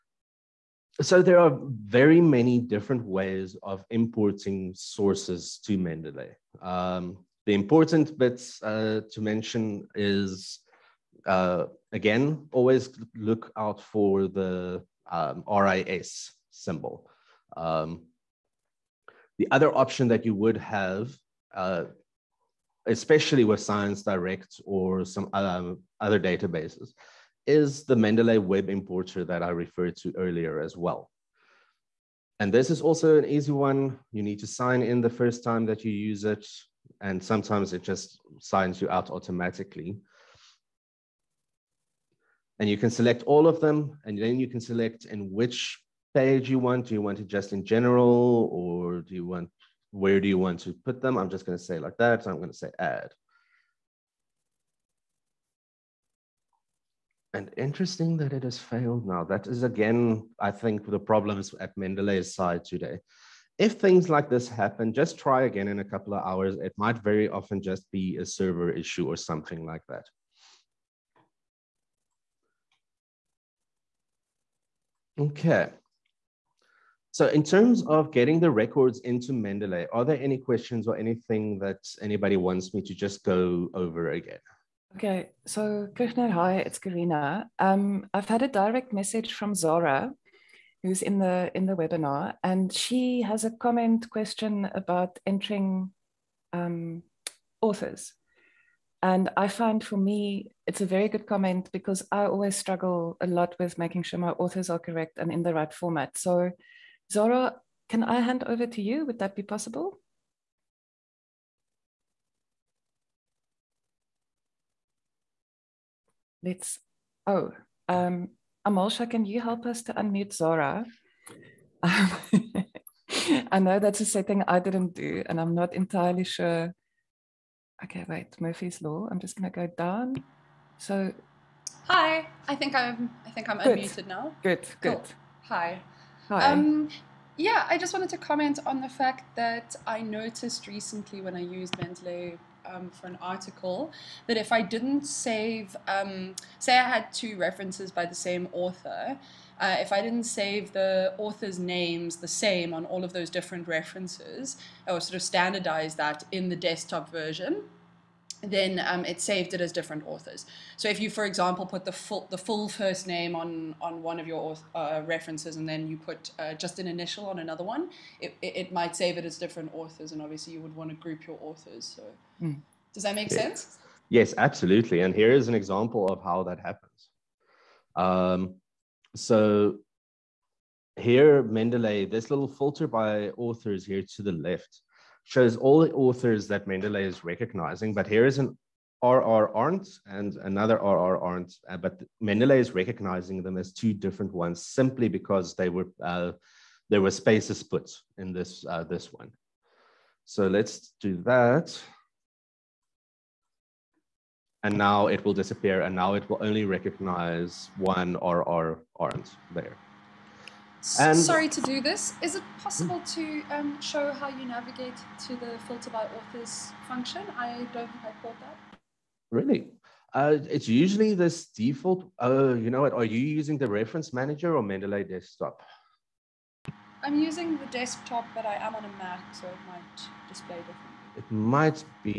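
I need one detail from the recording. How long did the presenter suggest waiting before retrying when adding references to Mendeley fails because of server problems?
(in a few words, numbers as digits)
a couple of hours.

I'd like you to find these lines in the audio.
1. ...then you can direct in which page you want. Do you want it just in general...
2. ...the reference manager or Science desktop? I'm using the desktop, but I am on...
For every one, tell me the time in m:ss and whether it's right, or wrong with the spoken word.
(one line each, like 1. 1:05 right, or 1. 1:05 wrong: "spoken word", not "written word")
1. 0:44 wrong: "select", not "direct"
2. 3:43 wrong: "Mendeley", not "Science".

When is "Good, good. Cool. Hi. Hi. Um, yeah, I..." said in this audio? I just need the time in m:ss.
2:14.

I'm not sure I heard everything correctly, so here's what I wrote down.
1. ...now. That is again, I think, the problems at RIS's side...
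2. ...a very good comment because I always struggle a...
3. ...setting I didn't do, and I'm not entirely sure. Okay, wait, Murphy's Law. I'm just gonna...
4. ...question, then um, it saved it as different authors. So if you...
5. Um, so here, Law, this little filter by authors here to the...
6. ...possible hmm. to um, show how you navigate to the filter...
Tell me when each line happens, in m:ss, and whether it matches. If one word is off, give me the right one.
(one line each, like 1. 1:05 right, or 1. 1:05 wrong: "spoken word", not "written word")
1. 0:59 wrong: "Mendeley", not "RIS"
2. 1:40 right
3. 2:04 right
4. 2:37 wrong: "version", not "question"
5. 2:57 wrong: "Mendeley", not "Law"
6. 3:32 right.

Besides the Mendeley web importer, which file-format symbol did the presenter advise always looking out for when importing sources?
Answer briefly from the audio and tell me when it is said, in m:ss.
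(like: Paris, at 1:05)
RIS, at 0:15.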